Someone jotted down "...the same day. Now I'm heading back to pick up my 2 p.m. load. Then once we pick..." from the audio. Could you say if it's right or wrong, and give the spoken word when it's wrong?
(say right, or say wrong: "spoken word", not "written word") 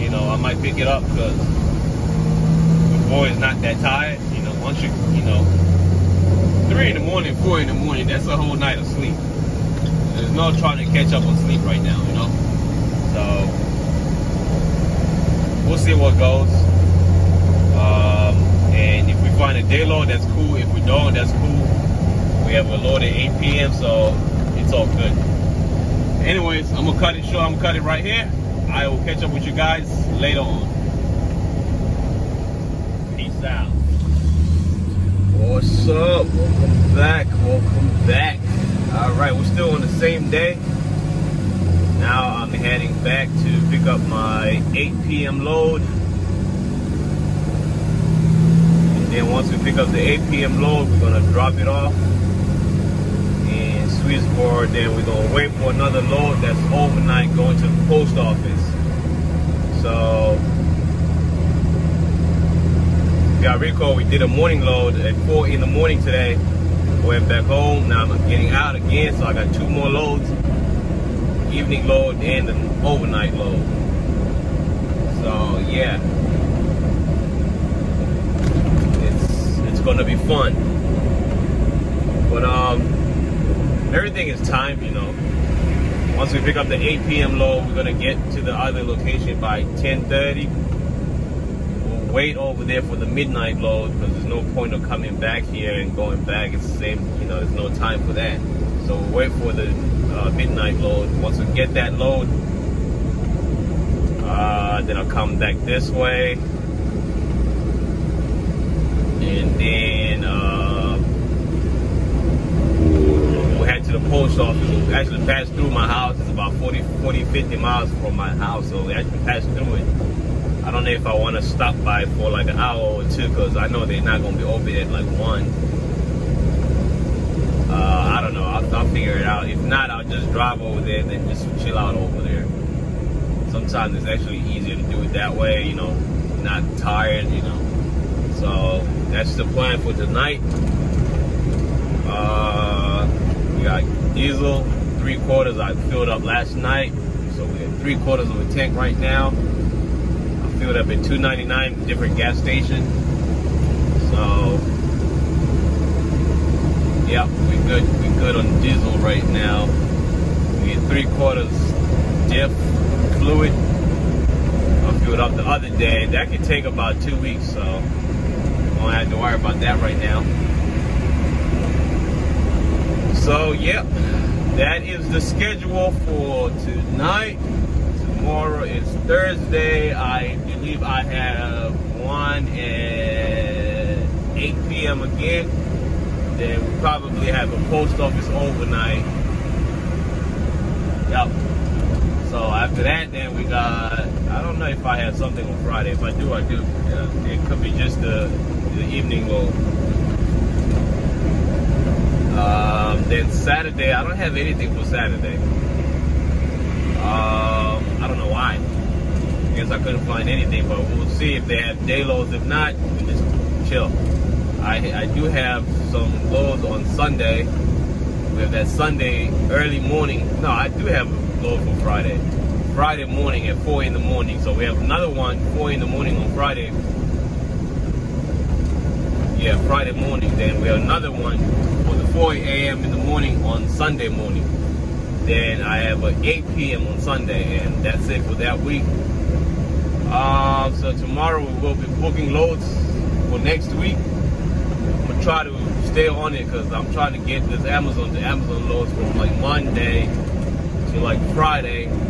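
wrong: "8", not "2".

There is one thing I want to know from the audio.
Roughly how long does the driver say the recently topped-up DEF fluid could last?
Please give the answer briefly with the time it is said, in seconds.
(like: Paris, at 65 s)
2 weeks, at 166 s.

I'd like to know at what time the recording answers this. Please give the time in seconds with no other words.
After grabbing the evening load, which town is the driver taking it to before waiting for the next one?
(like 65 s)
53 s.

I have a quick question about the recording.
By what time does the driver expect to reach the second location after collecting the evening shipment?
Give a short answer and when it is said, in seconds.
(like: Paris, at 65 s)
10:30, at 89 s.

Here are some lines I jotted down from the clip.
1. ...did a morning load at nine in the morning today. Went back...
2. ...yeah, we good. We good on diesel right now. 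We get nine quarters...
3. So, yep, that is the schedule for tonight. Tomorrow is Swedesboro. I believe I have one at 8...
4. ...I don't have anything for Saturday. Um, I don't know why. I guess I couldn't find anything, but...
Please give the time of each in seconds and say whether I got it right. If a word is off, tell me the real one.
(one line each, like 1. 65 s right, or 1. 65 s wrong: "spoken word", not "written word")
1. 64 s wrong: "four", not "nine"
2. 157 s wrong: "three", not "nine"
3. 173 s wrong: "Thursday", not "Swedesboro"
4. 203 s right.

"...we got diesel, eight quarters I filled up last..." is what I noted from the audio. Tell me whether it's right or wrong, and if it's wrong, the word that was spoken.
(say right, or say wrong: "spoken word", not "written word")
wrong: "three", not "eight".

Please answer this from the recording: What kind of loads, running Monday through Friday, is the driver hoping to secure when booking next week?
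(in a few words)
Amazon to Amazon loads.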